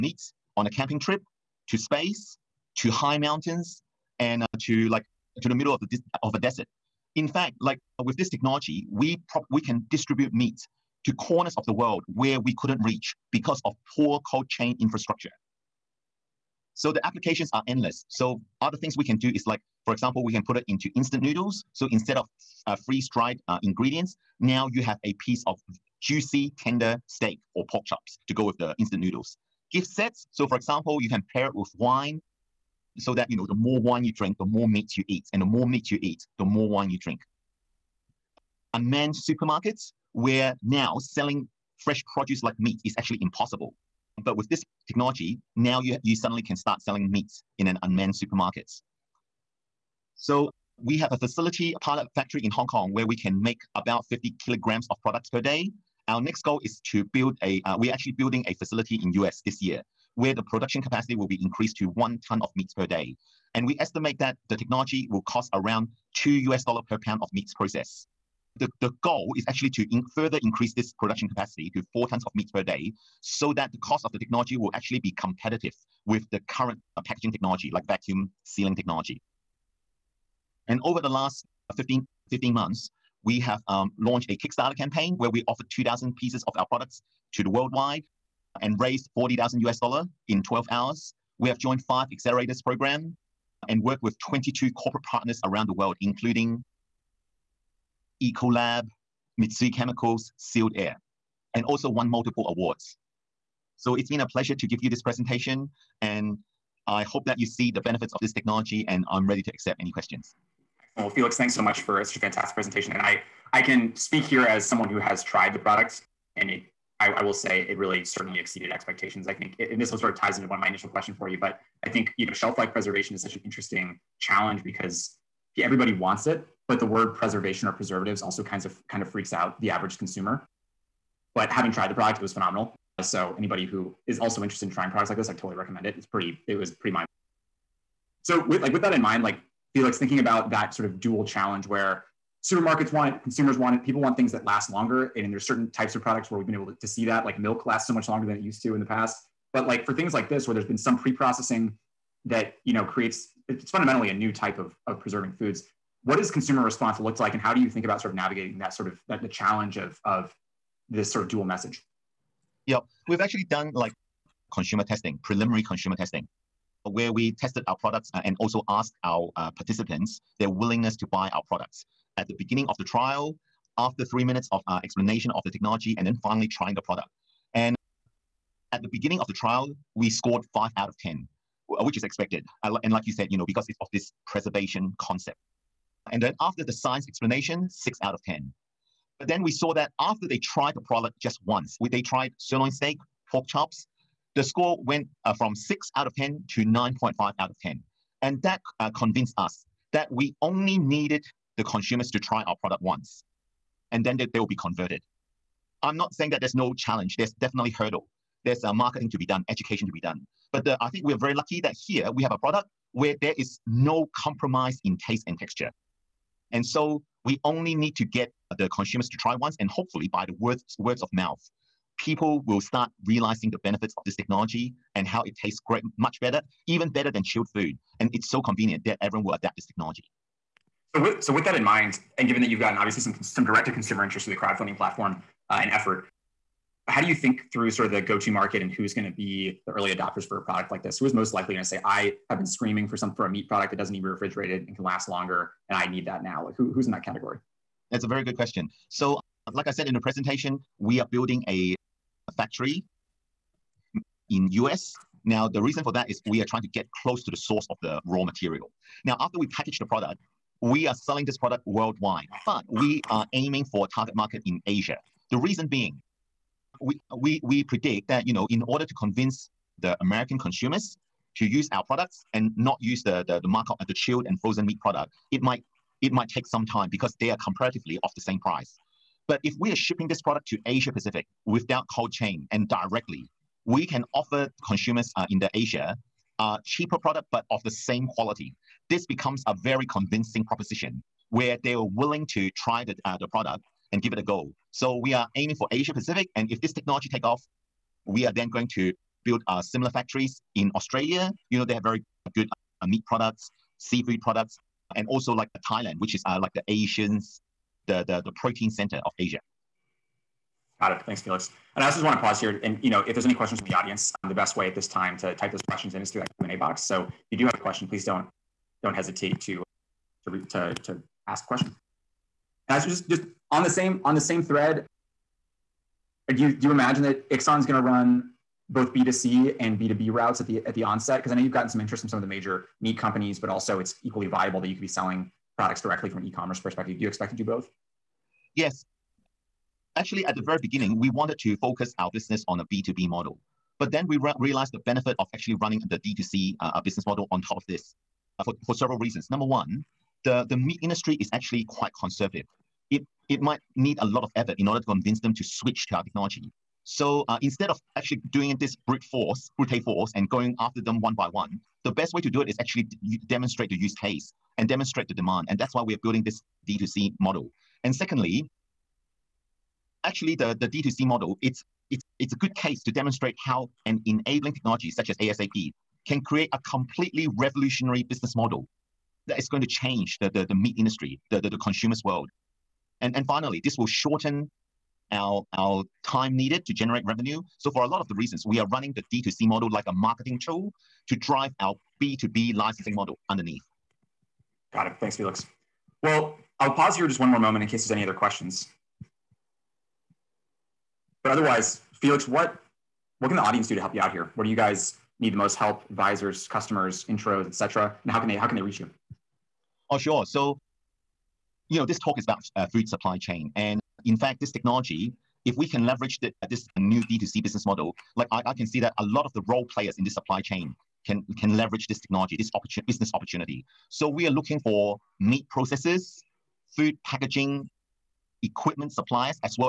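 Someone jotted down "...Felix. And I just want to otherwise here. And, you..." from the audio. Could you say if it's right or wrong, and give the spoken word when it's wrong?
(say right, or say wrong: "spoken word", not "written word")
wrong: "pause", not "otherwise".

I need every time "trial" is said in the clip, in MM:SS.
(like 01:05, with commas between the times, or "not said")
02:52, 02:59.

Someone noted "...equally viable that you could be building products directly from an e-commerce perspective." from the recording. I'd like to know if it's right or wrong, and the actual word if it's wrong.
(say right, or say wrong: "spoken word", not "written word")
wrong: "selling", not "building".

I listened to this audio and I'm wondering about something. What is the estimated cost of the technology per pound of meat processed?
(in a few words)
$2.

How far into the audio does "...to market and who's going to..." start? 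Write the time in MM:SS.
03:58.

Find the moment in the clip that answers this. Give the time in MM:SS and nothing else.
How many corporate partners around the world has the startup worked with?
01:34.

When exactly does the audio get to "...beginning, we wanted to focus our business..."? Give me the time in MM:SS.
05:40.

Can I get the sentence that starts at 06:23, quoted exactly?
And, and finally, this will shorten our, our time needed to generate revenue.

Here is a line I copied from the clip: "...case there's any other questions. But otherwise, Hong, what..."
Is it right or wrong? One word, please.
wrong.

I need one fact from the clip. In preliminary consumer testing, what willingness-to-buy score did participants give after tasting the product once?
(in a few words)
9.5 out of 10.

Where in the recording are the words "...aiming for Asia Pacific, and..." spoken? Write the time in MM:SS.
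04:55.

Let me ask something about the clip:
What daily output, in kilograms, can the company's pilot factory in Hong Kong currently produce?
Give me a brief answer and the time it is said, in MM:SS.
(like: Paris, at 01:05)
50 kilograms, at 00:54.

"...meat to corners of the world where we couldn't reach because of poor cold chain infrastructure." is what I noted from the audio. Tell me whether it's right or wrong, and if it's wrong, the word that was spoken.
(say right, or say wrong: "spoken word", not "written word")
right.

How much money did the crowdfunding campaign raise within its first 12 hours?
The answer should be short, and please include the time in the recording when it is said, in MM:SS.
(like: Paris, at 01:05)
$40,000, at 01:29.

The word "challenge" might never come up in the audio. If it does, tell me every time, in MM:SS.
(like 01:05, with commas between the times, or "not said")
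02:04, 02:21, 02:39, 03:26.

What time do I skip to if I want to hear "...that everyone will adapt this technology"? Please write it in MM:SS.
03:48.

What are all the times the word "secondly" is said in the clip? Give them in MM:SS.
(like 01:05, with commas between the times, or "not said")
06:07.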